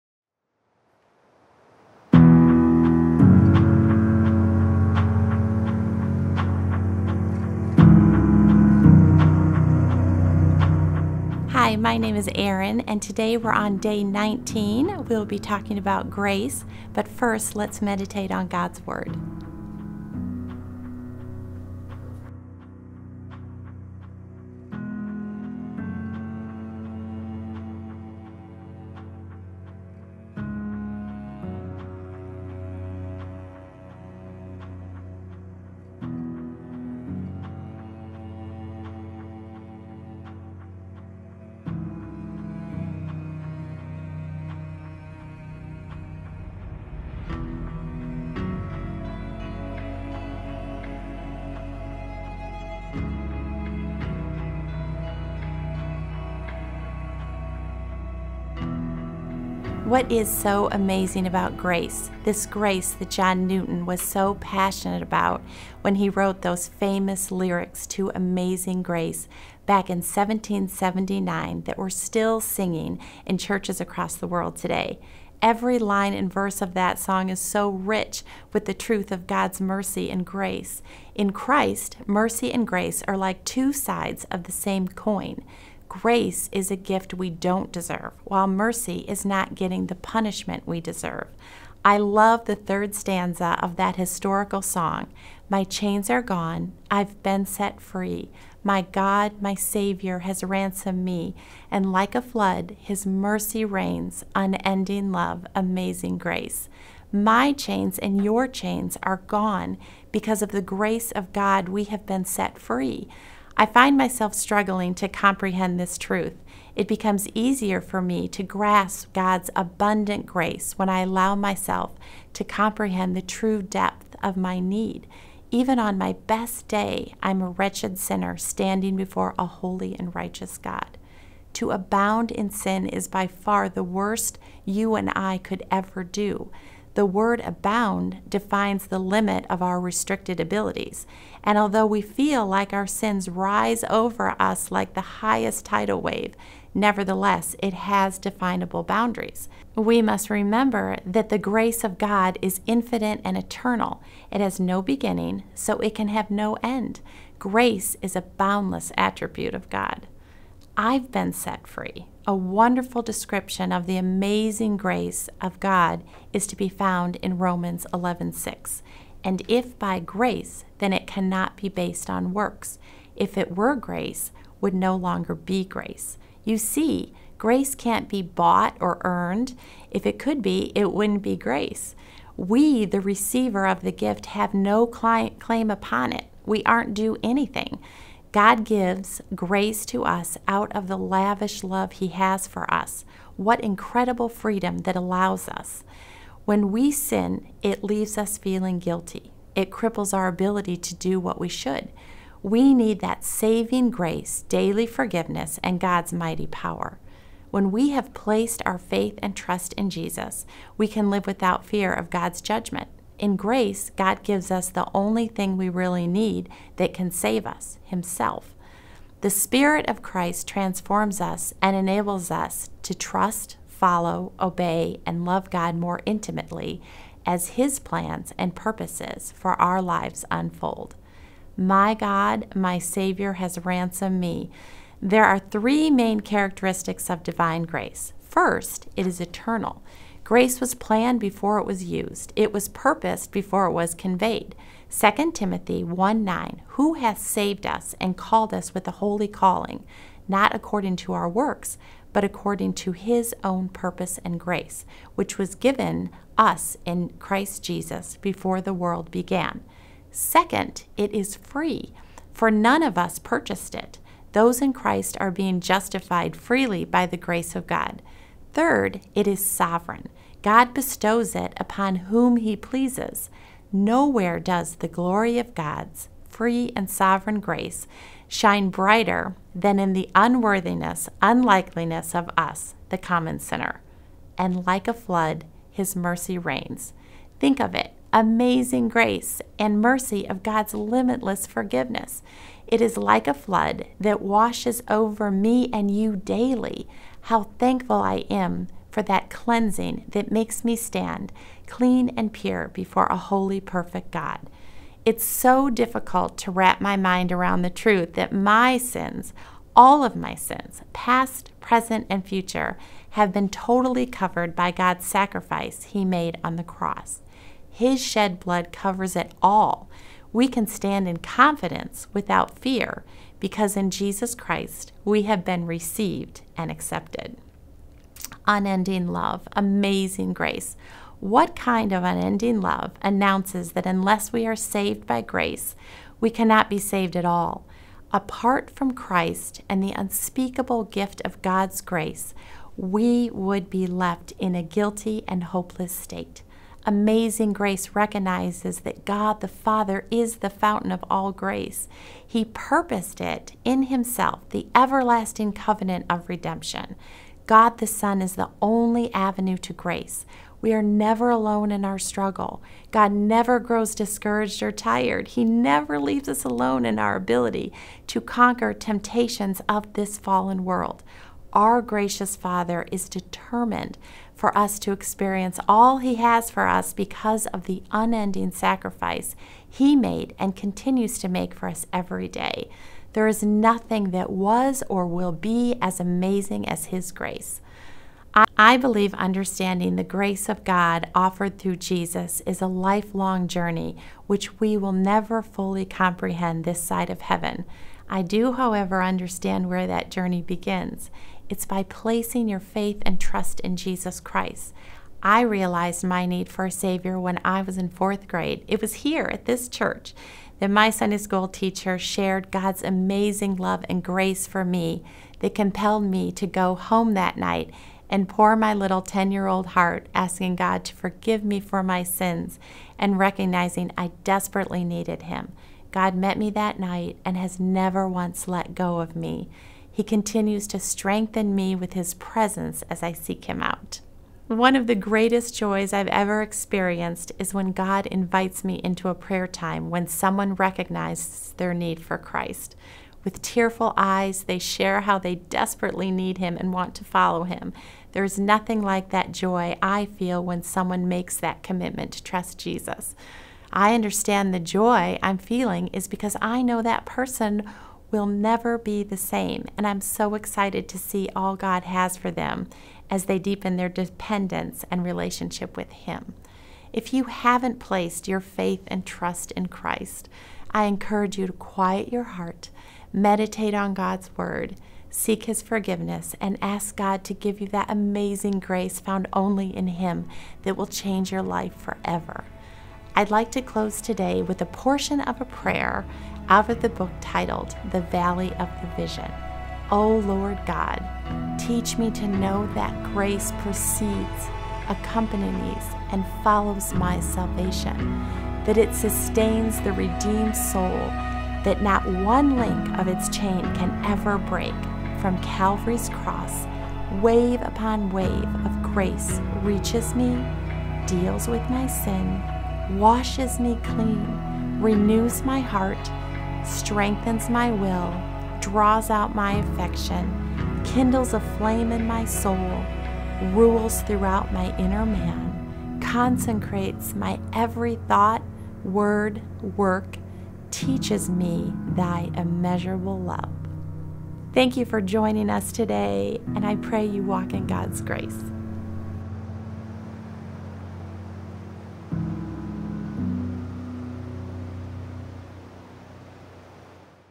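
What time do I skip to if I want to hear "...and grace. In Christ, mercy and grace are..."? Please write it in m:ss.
1:20.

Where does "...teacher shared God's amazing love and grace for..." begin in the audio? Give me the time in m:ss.
6:51.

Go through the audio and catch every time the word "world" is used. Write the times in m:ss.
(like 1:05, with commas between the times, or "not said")
1:14, 4:18, 6:10.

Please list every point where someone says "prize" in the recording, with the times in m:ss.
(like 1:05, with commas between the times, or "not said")
not said.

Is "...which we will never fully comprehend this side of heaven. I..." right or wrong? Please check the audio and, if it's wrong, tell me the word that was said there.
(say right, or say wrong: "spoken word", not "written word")
right.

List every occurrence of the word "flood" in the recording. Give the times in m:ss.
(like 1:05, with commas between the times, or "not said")
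1:42, 4:44, 4:53.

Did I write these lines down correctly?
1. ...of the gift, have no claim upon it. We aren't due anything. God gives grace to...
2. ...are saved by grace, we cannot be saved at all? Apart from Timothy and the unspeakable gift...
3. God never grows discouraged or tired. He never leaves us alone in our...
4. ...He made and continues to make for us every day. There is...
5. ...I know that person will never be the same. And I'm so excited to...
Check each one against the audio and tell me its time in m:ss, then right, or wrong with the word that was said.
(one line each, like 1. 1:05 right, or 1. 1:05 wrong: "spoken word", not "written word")
1. 3:03 right
2. 5:34 wrong: "Christ", not "Timothy"
3. 6:02 right
4. 6:19 right
5. 7:36 right.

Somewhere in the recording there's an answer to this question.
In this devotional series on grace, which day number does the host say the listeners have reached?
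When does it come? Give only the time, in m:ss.
0:14.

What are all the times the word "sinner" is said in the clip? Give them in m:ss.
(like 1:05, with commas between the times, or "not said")
2:07, 4:43.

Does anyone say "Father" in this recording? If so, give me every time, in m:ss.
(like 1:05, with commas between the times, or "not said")
5:49, 6:12.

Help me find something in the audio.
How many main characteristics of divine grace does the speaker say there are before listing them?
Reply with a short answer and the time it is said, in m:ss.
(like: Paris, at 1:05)
3, at 3:55.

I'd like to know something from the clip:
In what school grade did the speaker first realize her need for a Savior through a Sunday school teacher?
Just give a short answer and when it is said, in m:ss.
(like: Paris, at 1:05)
fourth grade, at 6:47.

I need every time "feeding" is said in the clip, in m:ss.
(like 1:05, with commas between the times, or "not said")
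not said.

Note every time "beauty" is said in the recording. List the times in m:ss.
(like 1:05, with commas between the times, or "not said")
not said.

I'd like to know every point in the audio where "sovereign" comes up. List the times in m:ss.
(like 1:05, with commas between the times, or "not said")
4:29, 4:36.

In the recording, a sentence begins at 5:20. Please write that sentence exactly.
We can stand in confidence without fear because in Jesus Christ we have been received and accepted unending love, amazing grace.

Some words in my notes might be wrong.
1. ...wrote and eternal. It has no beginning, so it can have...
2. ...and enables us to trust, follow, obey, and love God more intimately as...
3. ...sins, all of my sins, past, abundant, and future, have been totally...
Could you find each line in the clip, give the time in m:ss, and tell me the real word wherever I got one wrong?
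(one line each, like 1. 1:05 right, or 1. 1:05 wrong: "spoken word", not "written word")
1. 2:32 wrong: "infinite", not "wrote"
2. 3:41 right
3. 5:08 wrong: "present", not "abundant".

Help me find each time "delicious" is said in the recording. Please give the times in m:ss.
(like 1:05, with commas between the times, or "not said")
not said.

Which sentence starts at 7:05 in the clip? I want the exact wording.
God met me that night and has never once let go of me.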